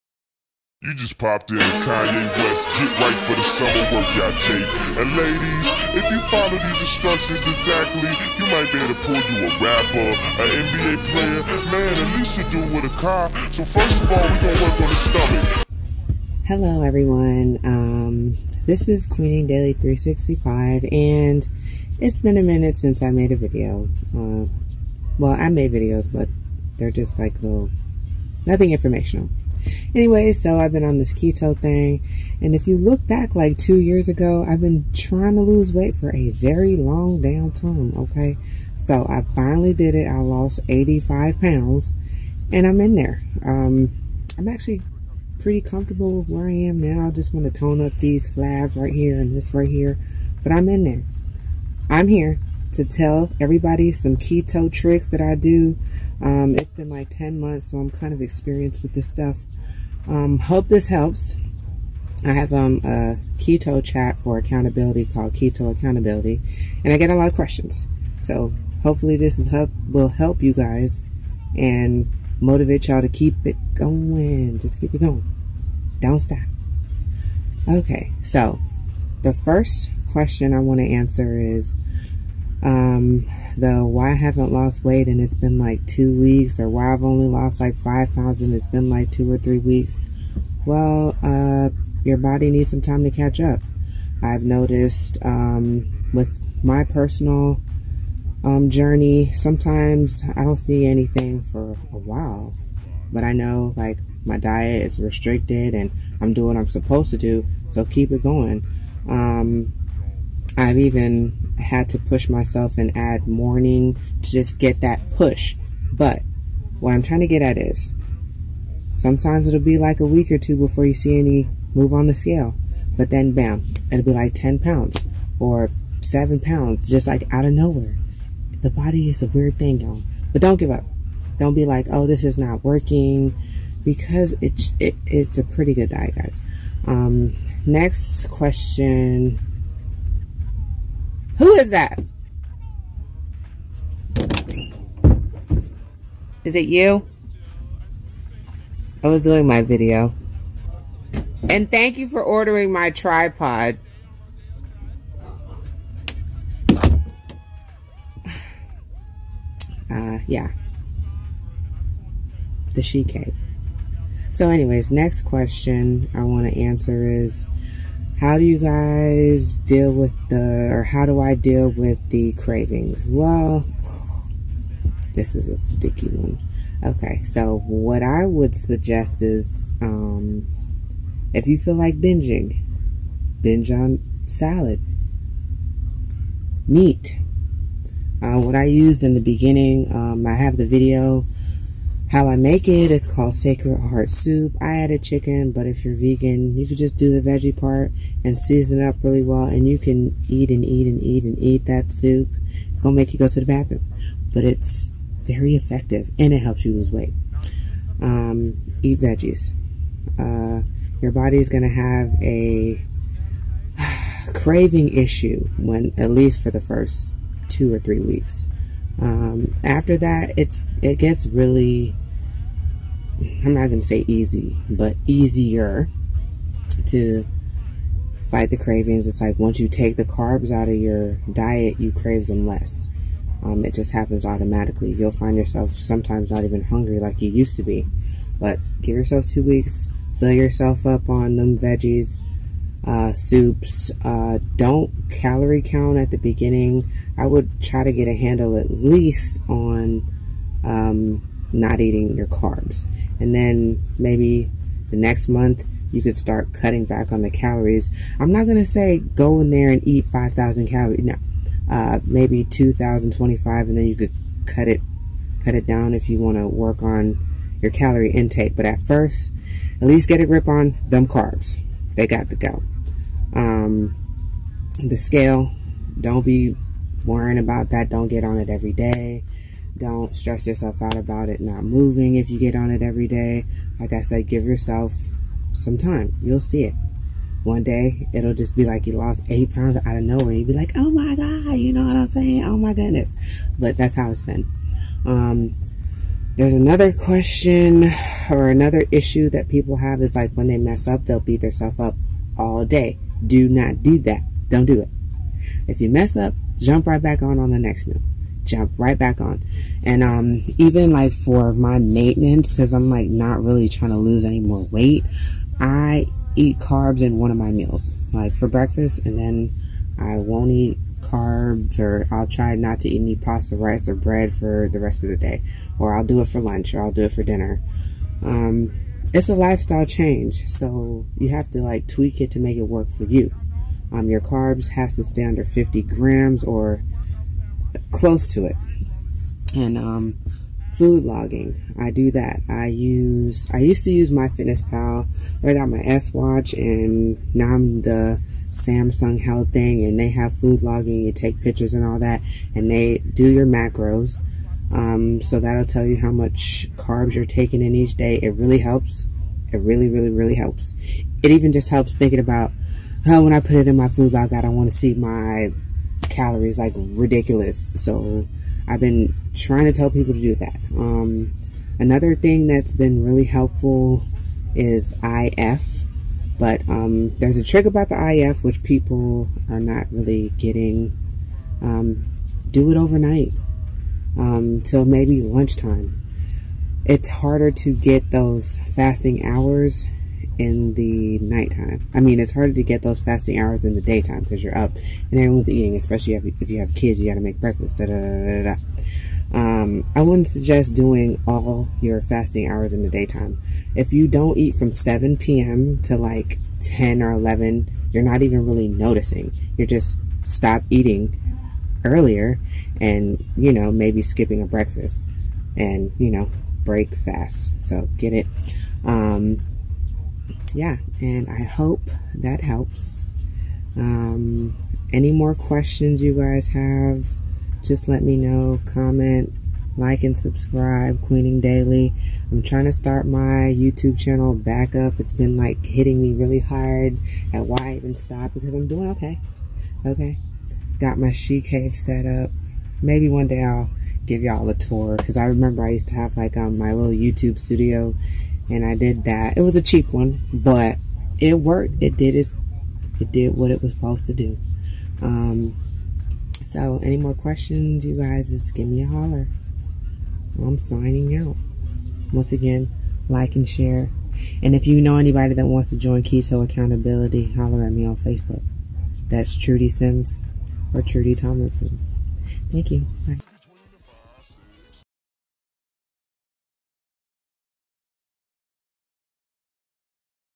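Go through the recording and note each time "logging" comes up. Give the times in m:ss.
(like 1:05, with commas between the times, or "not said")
5:41, 5:50.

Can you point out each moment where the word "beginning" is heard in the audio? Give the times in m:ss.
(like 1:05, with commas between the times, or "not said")
3:09, 4:06.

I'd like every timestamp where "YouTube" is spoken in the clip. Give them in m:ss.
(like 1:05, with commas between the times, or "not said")
7:13, 7:26.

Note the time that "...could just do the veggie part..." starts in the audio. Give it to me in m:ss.
3:16.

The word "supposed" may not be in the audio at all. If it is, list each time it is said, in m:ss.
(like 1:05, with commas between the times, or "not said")
1:46, 7:33.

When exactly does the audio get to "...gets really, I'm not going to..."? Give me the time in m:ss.
3:40.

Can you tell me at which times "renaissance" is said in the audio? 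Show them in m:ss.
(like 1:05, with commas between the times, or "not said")
not said.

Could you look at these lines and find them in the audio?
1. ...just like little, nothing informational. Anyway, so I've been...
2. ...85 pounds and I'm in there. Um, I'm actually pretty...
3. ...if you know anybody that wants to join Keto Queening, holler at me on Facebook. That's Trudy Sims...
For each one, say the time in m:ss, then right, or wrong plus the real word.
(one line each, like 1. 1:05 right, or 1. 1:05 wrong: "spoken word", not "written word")
1. 0:26 right
2. 0:40 right
3. 7:44 wrong: "Accountability", not "Queening".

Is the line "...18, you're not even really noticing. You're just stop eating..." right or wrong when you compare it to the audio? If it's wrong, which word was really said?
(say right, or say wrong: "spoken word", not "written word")
wrong: "11", not "18".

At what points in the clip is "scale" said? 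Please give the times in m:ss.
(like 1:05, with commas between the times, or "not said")
2:02, 4:34.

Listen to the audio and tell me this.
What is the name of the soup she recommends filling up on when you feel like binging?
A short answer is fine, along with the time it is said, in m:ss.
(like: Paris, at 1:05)
Sacred heart soup, at 3:13.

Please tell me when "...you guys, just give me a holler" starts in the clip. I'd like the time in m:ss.
7:37.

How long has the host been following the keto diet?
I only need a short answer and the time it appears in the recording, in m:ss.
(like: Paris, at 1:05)
10 months, at 0:57.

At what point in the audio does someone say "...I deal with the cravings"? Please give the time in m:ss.
2:51.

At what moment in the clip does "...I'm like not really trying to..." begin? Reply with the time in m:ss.
5:12.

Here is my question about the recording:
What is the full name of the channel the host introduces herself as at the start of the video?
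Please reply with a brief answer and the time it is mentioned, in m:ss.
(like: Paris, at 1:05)
Queening Daily 365, at 0:19.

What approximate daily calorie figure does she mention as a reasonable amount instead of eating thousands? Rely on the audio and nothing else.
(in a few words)
2,025.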